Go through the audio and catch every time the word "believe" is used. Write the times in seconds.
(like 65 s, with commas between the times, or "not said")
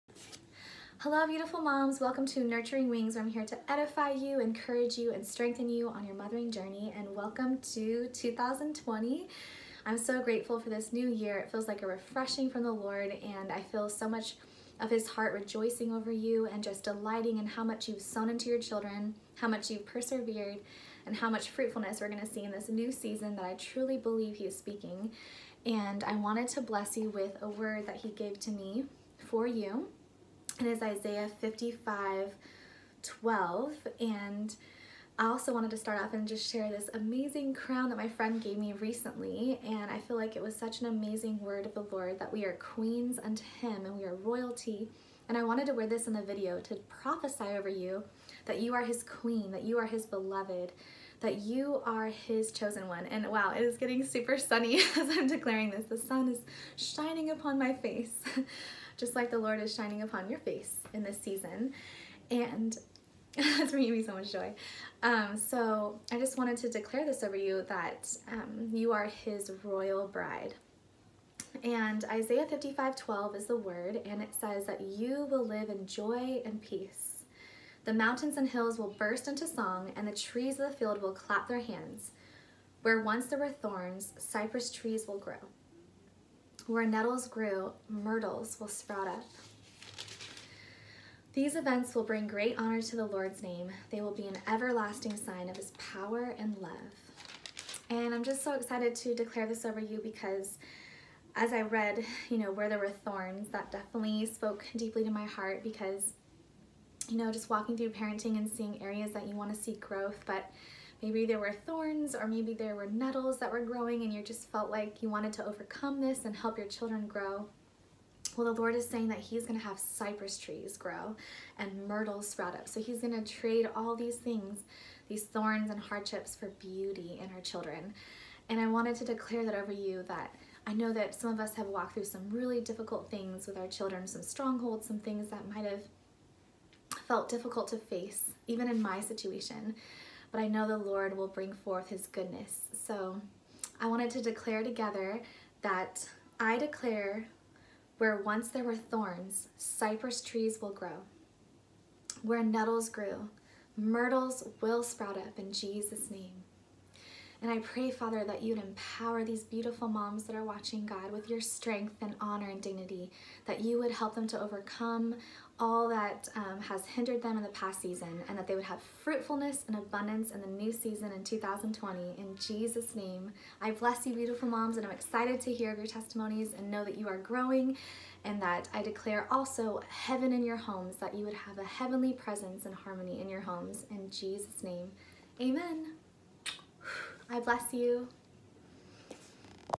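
23 s.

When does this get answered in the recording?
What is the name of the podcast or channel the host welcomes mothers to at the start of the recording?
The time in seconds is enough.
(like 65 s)
2 s.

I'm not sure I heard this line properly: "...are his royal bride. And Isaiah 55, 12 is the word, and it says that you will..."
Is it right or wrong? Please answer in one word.
right.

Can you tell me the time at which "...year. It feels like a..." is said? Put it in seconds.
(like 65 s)
11 s.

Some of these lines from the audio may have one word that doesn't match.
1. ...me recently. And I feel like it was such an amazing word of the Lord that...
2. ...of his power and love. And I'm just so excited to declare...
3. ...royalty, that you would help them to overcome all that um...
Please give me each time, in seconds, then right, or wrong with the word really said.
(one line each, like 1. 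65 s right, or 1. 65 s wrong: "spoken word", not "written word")
1. 38 s right
2. 95 s right
3. 162 s wrong: "dignity", not "royalty".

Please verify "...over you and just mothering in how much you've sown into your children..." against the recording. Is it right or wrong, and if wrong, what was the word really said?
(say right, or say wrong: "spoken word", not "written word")
wrong: "delighting", not "mothering".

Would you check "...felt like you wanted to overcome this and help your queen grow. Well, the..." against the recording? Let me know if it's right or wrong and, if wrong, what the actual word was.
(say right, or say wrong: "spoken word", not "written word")
wrong: "children", not "queen".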